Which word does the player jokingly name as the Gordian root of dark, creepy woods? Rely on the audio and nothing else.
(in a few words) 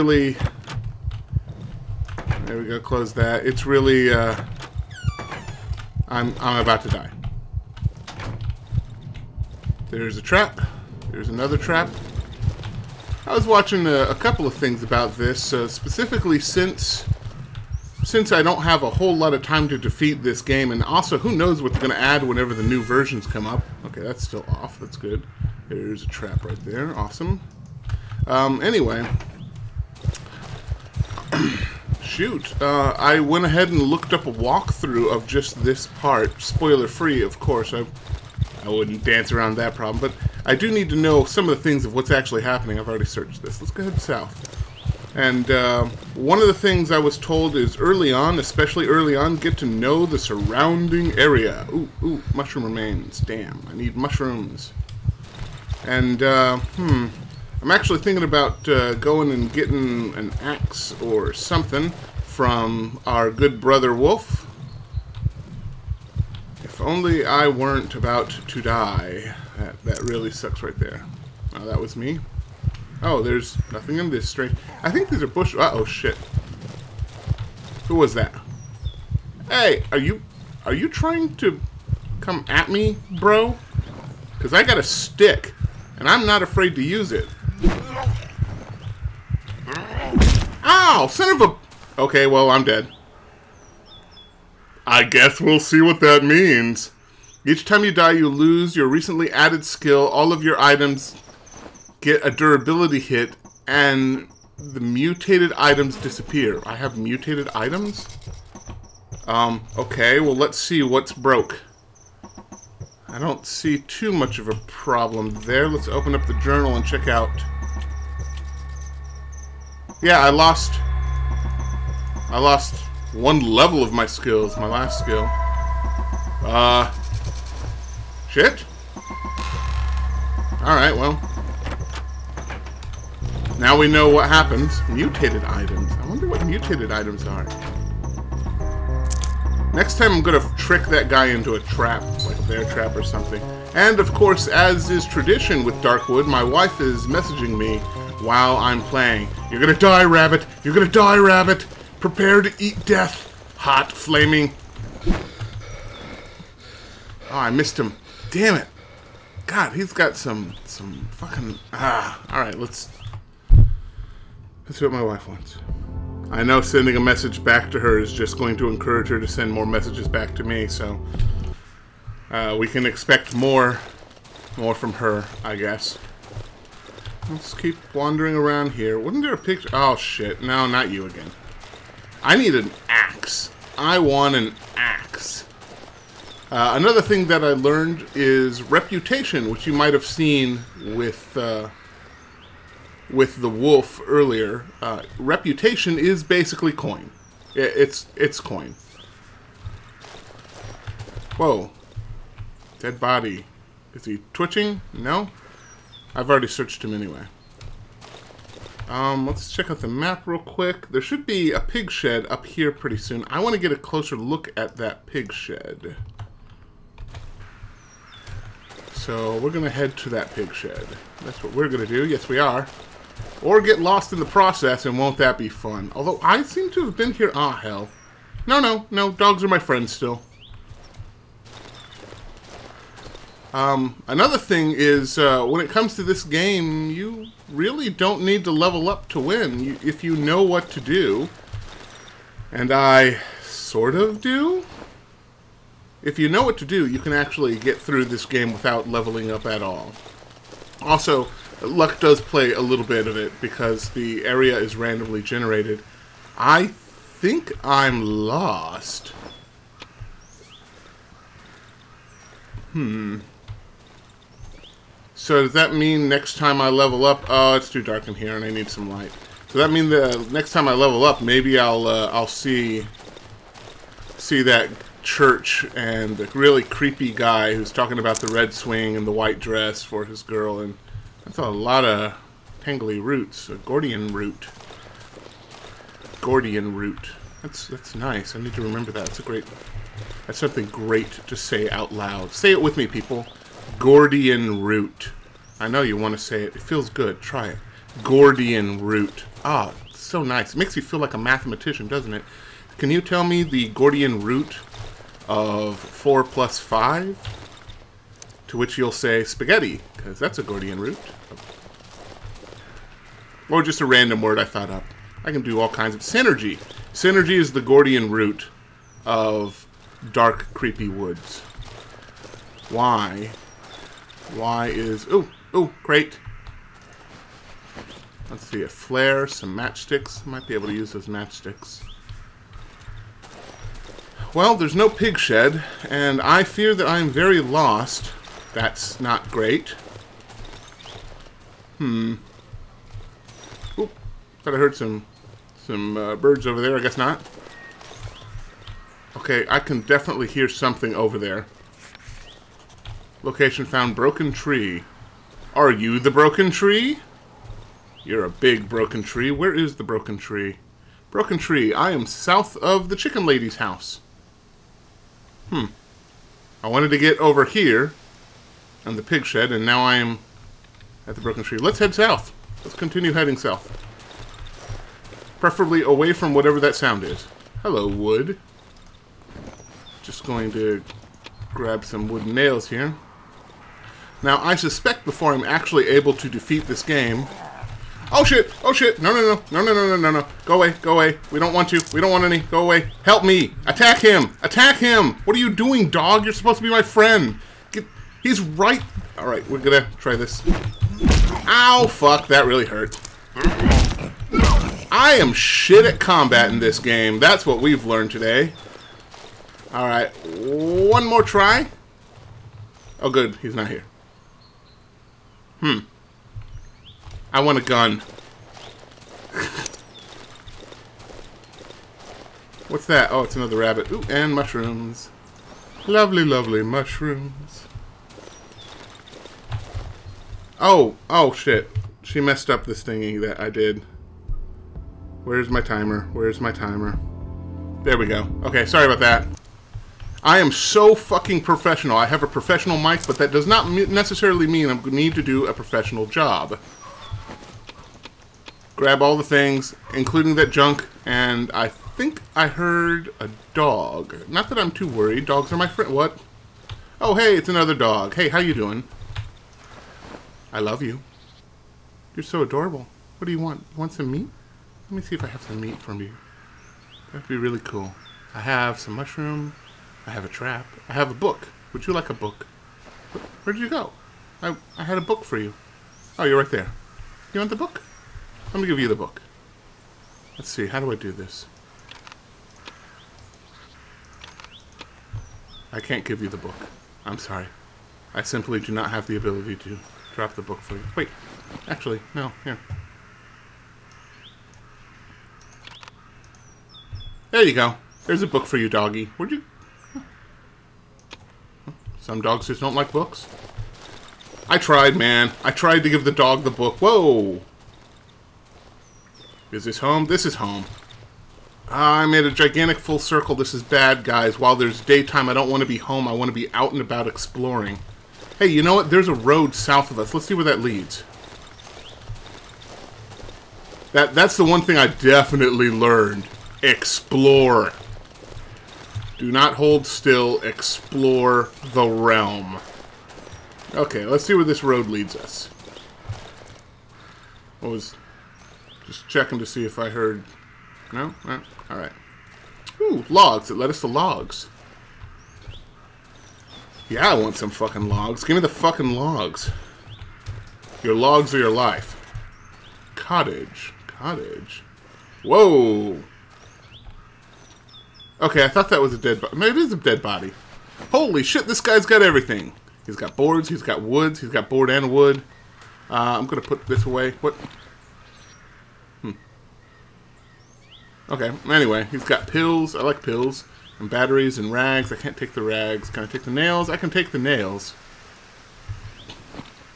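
Synergy.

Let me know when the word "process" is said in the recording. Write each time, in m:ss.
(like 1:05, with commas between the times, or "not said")
3:44.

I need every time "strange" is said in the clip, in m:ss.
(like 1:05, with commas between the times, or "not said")
1:14.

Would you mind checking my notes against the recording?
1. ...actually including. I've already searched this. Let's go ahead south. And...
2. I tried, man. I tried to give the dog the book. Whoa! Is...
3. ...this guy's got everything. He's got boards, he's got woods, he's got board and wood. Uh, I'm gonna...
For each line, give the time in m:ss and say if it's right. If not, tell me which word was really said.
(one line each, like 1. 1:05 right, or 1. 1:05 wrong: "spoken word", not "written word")
1. 0:42 wrong: "happening", not "including"
2. 8:24 right
3. 9:21 right.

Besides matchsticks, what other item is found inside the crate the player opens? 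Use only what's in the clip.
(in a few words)
a flare.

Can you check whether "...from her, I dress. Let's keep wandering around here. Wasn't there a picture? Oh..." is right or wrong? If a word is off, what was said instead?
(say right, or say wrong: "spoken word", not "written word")
wrong: "guess", not "dress".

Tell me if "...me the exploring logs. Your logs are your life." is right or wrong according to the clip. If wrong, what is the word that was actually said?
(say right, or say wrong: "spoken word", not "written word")
wrong: "fucking", not "exploring".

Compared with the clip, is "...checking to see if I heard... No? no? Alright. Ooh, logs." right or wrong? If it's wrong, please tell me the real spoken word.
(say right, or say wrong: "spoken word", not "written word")
right.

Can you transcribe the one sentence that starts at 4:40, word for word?
And that's a lot of tangly roots, a Gordian root.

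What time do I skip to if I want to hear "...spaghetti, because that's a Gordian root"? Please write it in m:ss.
5:09.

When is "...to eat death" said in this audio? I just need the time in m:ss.
2:32.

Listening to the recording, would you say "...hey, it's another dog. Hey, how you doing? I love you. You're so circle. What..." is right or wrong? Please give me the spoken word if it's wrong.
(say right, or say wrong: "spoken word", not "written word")
wrong: "adorable", not "circle".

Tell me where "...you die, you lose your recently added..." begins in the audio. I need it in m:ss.
1:37.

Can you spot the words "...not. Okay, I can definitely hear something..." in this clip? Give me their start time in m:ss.
5:46.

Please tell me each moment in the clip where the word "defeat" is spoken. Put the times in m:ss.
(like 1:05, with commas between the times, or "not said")
0:19, 6:26.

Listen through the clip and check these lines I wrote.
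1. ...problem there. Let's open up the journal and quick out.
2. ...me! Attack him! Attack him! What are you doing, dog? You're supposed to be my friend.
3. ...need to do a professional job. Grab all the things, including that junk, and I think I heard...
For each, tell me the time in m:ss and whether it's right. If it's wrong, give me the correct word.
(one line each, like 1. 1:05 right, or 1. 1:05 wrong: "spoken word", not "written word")
1. 1:54 wrong: "check", not "quick"
2. 6:33 right
3. 7:24 right.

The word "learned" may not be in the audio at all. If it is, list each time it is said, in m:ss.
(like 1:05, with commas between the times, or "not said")
3:07, 6:47, 8:45.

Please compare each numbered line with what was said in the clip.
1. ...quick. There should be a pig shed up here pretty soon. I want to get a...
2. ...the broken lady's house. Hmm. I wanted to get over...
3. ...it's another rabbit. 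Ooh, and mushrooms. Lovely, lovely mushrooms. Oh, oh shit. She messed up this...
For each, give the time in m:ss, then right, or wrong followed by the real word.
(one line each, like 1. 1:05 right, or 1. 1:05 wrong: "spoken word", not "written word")
1. 3:30 right
2. 6:02 wrong: "chicken", not "broken"
3. 7:03 right.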